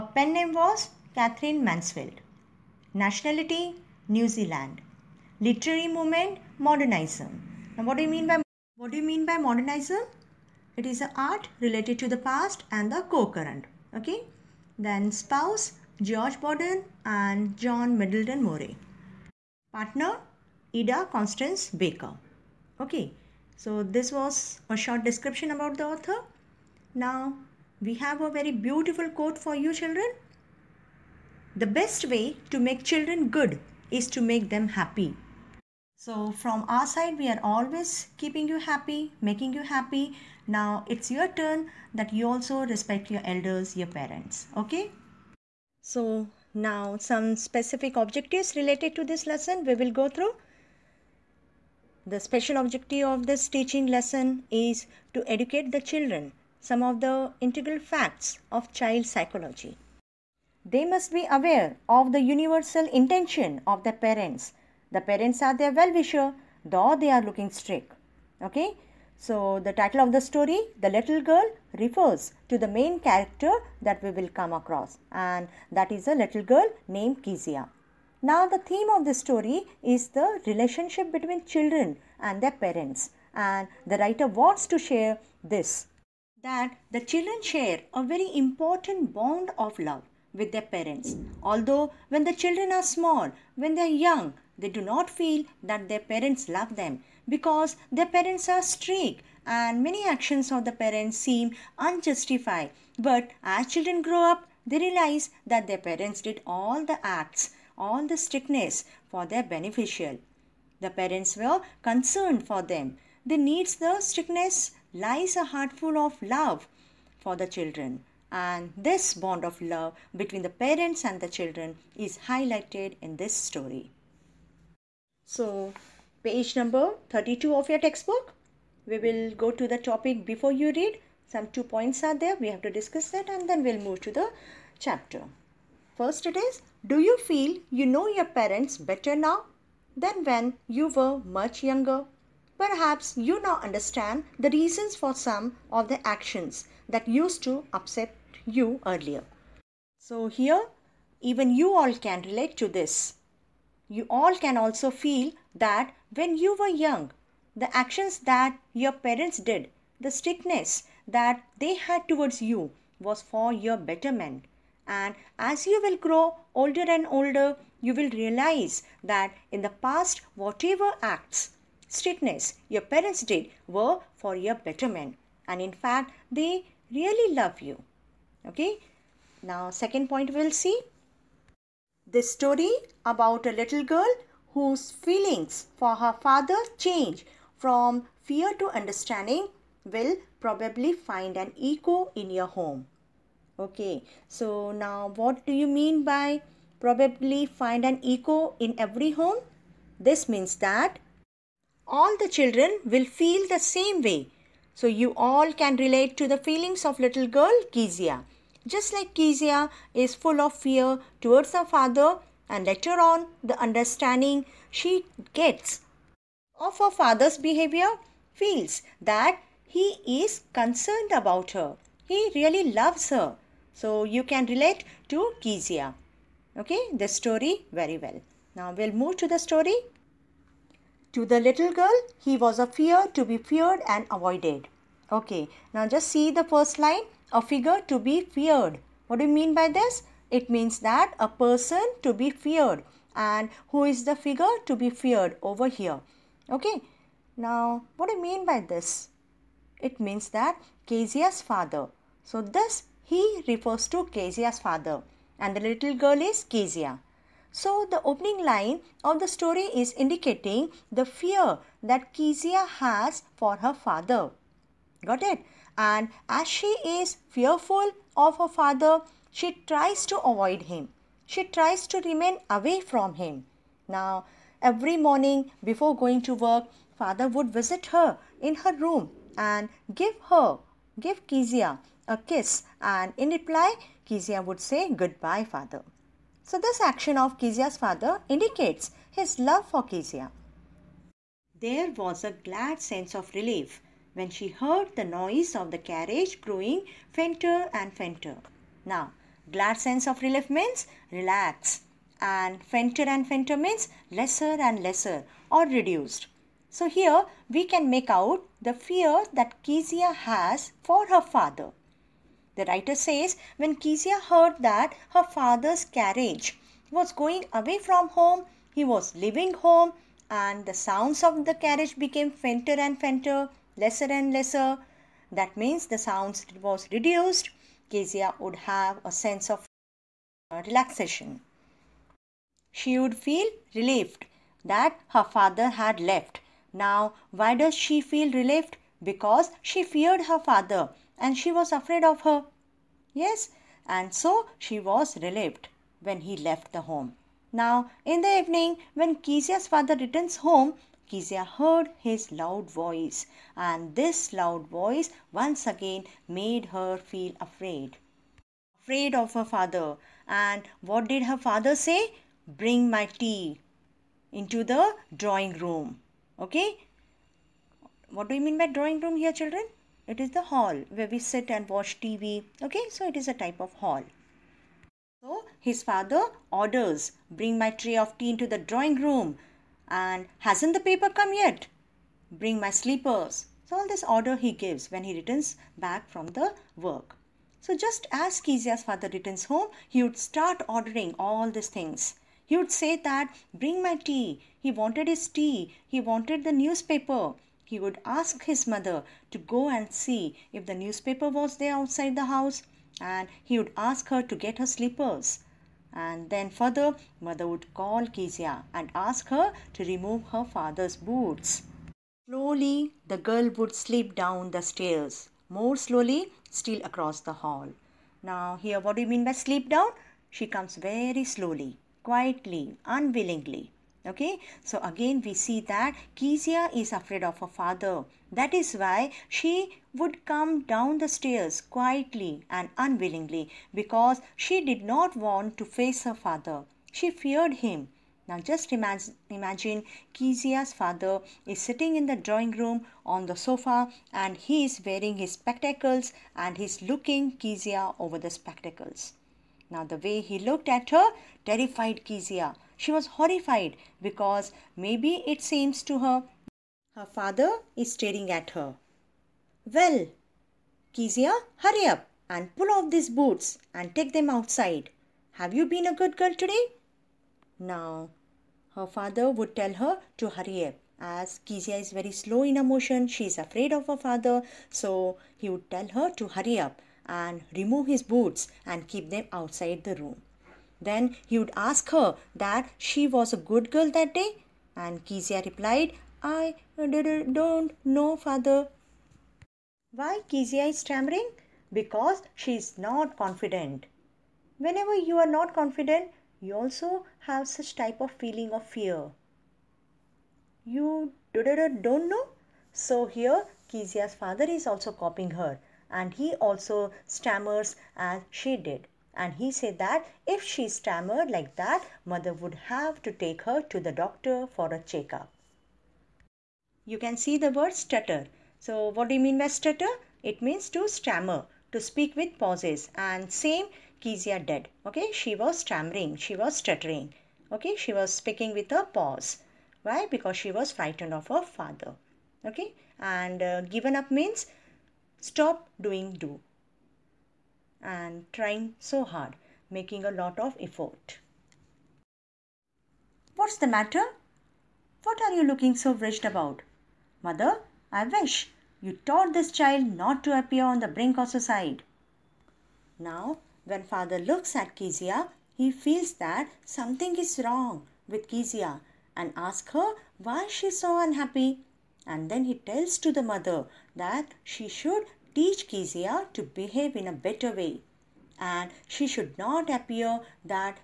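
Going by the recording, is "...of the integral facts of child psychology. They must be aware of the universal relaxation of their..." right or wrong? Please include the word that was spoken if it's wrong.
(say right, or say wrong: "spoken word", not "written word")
wrong: "intention", not "relaxation".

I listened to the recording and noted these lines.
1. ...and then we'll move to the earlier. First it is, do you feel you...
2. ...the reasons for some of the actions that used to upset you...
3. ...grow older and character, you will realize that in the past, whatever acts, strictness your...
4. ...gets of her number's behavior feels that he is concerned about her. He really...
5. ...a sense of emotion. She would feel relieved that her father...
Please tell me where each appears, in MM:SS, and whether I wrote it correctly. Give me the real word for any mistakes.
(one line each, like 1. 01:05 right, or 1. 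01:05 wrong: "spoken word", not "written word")
1. 02:13 wrong: "chapter", not "earlier"
2. 02:24 right
3. 02:45 wrong: "older", not "character"
4. 03:35 wrong: "father", not "number"
5. 05:29 wrong: "relaxation", not "emotion".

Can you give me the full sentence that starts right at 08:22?
So here Kezia's father is also copying her and he also stammers as she did.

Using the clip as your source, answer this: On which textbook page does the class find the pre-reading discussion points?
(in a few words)
32.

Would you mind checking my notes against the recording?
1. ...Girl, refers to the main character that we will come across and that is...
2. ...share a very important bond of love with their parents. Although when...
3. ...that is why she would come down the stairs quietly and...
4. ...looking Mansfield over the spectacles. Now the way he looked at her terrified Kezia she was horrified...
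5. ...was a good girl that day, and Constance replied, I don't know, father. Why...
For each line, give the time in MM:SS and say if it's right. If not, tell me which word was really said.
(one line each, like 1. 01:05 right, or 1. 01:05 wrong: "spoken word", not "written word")
1. 01:11 right
2. 01:27 right
3. 07:08 right
4. 07:26 wrong: "Kezia", not "Mansfield"
5. 08:03 wrong: "Kezia", not "Constance".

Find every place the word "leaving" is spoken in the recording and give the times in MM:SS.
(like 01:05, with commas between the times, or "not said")
05:19.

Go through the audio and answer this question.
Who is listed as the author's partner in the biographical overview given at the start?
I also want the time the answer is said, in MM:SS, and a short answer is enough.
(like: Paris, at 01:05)
Ida Constance Baker, at 00:20.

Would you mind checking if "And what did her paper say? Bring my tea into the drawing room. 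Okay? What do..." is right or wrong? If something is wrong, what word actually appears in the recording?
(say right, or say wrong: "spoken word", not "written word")
wrong: "father", not "paper".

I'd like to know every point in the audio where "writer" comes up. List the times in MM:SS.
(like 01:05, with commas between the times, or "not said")
01:23, 05:12.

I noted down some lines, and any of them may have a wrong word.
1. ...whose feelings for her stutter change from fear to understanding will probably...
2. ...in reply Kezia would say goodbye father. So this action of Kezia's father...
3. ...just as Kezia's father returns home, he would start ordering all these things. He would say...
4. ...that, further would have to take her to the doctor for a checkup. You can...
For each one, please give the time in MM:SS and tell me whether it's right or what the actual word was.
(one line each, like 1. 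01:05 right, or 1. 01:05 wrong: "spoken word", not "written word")
1. 03:04 wrong: "father", not "stutter"
2. 04:43 right
3. 06:27 right
4. 08:31 wrong: "mother", not "further".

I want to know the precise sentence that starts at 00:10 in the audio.
It is an art related to the past and the co-current.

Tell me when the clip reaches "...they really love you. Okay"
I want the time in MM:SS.
02:56.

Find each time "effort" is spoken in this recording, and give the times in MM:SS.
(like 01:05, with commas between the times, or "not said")
09:00.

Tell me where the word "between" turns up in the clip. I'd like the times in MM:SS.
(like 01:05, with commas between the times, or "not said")
01:21, 02:00.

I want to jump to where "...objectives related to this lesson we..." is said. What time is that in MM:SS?
00:47.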